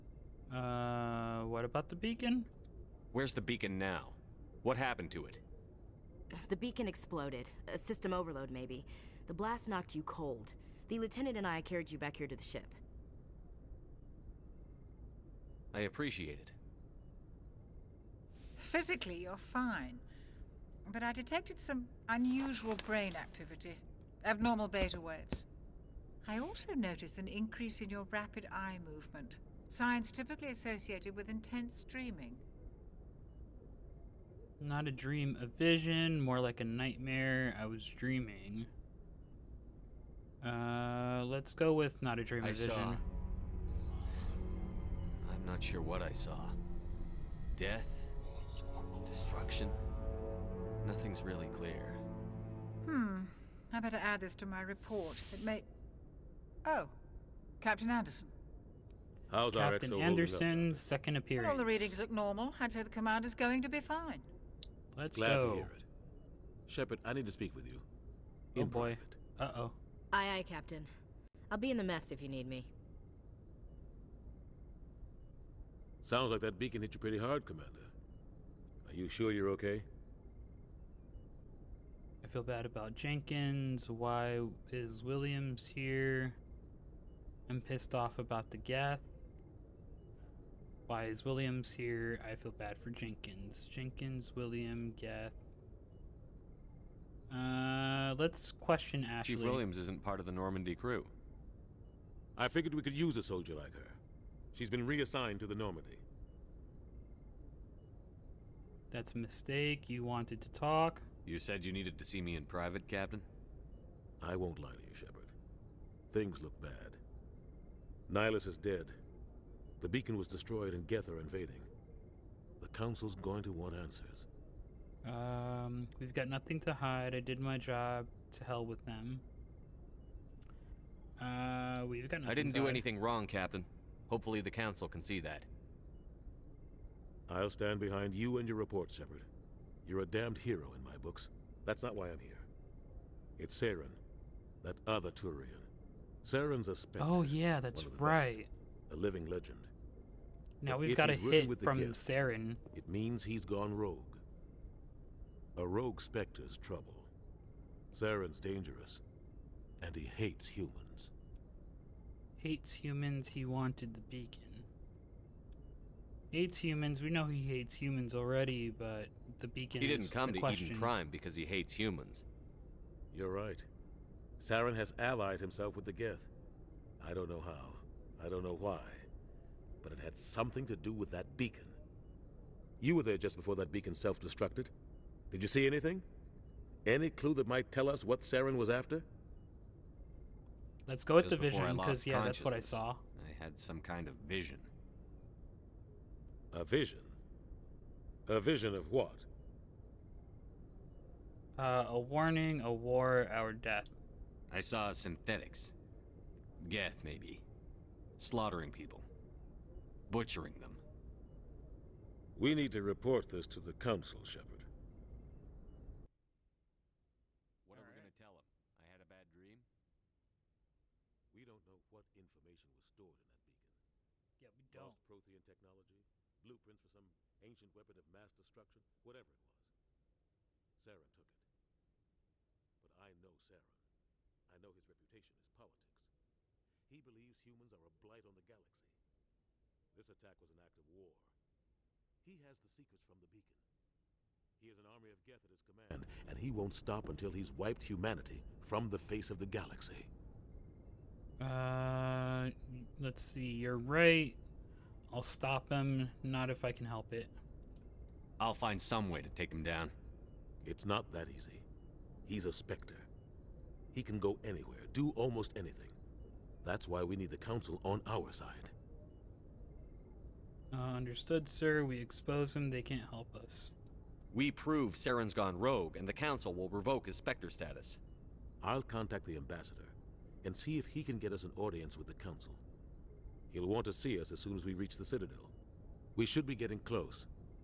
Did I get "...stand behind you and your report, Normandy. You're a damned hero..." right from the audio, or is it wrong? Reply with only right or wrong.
wrong.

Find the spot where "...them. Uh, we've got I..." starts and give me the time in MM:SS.
02:08.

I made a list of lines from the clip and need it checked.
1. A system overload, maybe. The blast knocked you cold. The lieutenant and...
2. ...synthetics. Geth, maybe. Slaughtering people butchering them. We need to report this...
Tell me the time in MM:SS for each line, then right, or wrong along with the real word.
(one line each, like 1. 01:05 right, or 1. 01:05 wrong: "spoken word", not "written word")
1. 00:07 right
2. 03:24 right.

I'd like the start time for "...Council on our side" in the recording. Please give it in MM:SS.
04:27.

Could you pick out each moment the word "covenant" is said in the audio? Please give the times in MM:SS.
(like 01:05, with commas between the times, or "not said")
not said.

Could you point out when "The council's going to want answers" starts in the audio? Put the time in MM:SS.
02:02.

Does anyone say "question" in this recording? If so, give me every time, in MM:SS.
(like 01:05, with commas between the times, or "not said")
01:38, 02:50.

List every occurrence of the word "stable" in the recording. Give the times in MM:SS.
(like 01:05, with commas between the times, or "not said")
not said.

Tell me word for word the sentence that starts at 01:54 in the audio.
I won't lie to you, Shepard.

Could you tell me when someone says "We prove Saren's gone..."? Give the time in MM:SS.
04:34.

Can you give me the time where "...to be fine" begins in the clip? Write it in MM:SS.
01:03.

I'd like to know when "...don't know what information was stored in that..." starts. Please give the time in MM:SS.
03:41.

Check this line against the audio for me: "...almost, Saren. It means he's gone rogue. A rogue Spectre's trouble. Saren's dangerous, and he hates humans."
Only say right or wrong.
wrong.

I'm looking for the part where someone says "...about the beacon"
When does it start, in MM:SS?
00:01.